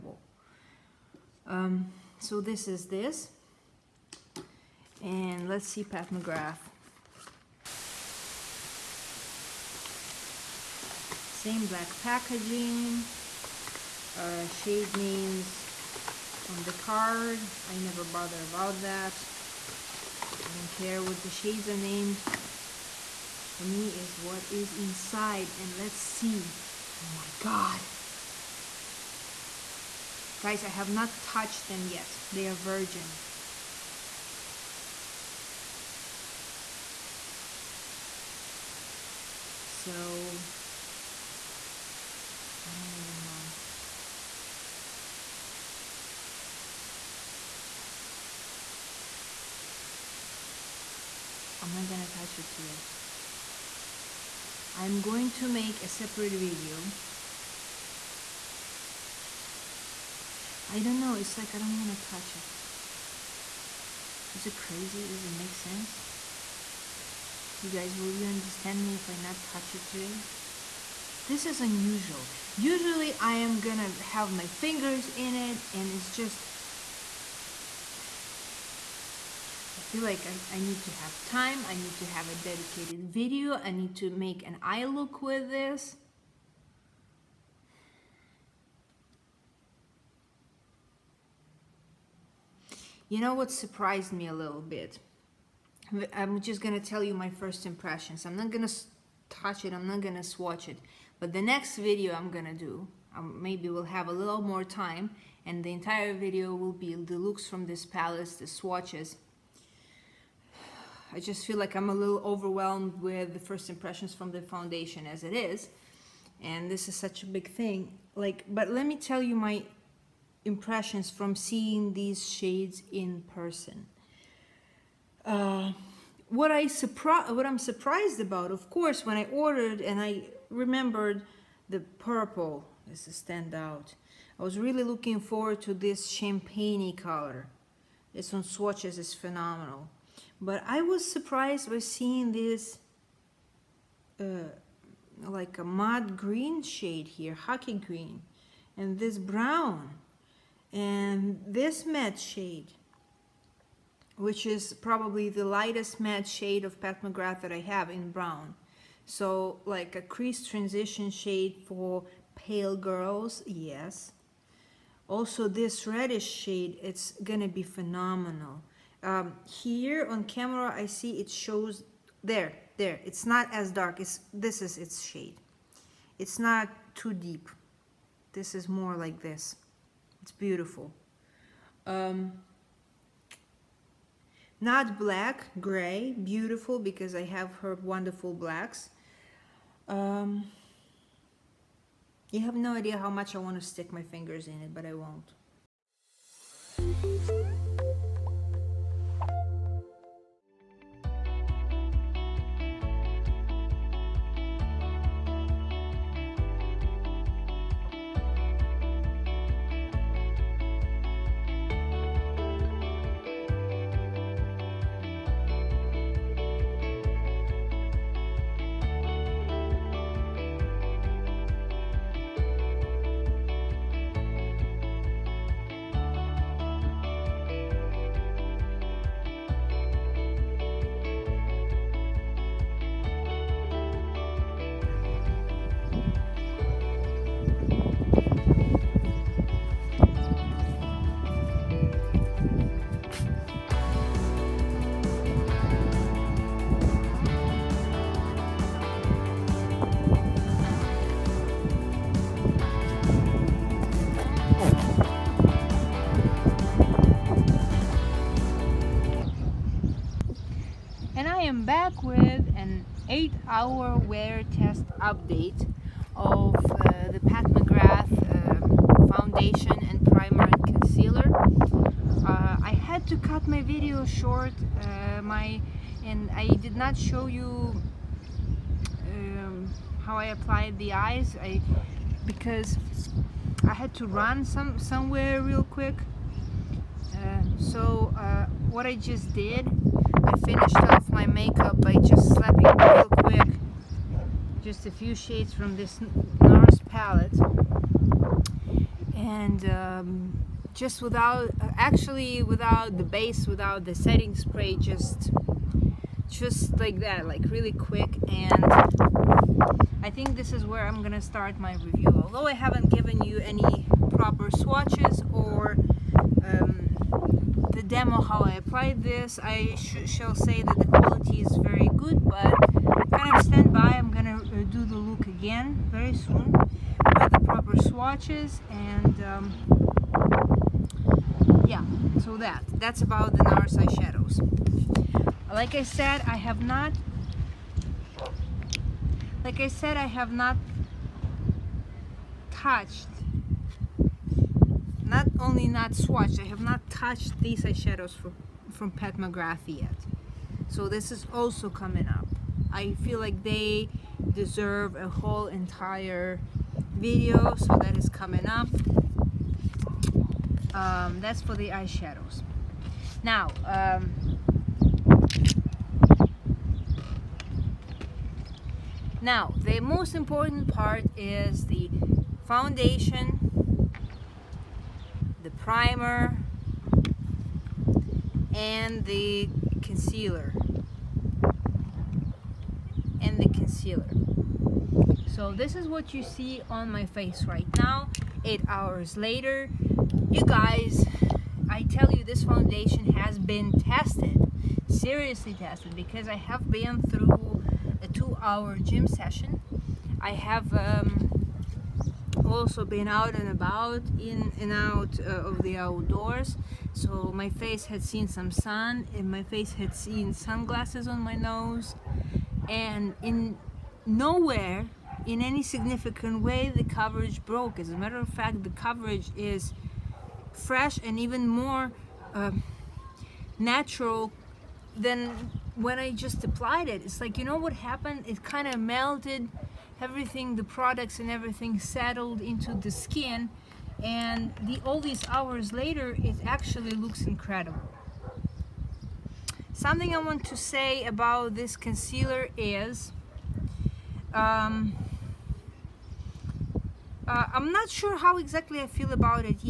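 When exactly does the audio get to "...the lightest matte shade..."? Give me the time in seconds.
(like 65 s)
155 s.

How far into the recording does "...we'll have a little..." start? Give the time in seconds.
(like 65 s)
103 s.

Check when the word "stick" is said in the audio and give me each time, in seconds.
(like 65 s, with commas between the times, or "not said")
193 s.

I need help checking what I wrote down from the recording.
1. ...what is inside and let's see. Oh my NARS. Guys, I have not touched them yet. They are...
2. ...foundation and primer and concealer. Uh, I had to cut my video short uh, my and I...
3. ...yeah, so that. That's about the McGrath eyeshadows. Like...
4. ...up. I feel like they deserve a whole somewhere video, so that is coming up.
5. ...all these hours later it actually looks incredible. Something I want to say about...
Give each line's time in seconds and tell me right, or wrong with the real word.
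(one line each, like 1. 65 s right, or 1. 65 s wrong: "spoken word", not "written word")
1. 24 s wrong: "God", not "NARS"
2. 269 s right
3. 331 s wrong: "NARS", not "McGrath"
4. 352 s wrong: "entire", not "somewhere"
5. 434 s right.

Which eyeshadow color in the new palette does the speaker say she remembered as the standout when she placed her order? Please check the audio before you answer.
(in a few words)
purple.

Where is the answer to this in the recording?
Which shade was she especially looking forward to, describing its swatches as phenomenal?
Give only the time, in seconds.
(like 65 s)
136 s.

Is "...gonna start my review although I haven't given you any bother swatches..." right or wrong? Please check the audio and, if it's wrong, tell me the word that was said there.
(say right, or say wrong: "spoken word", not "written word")
wrong: "proper", not "bother".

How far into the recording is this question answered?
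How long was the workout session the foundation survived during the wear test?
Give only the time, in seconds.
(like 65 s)
398 s.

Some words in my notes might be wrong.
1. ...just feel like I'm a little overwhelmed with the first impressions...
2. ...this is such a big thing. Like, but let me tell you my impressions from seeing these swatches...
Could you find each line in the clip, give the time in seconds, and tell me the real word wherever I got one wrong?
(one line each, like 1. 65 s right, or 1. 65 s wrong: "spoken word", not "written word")
1. 111 s right
2. 116 s wrong: "shades", not "swatches".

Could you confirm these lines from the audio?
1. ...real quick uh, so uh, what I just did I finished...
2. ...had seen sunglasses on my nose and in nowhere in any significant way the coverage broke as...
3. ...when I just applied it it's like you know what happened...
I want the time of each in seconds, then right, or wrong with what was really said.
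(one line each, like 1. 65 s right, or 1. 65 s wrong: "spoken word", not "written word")
1. 285 s right
2. 409 s right
3. 425 s right.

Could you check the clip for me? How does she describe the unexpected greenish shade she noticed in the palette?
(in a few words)
mud green.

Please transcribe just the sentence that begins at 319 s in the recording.
I sh shall say that the quality is very good, but kind of stand by.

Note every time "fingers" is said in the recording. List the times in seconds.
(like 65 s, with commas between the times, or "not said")
74 s, 194 s.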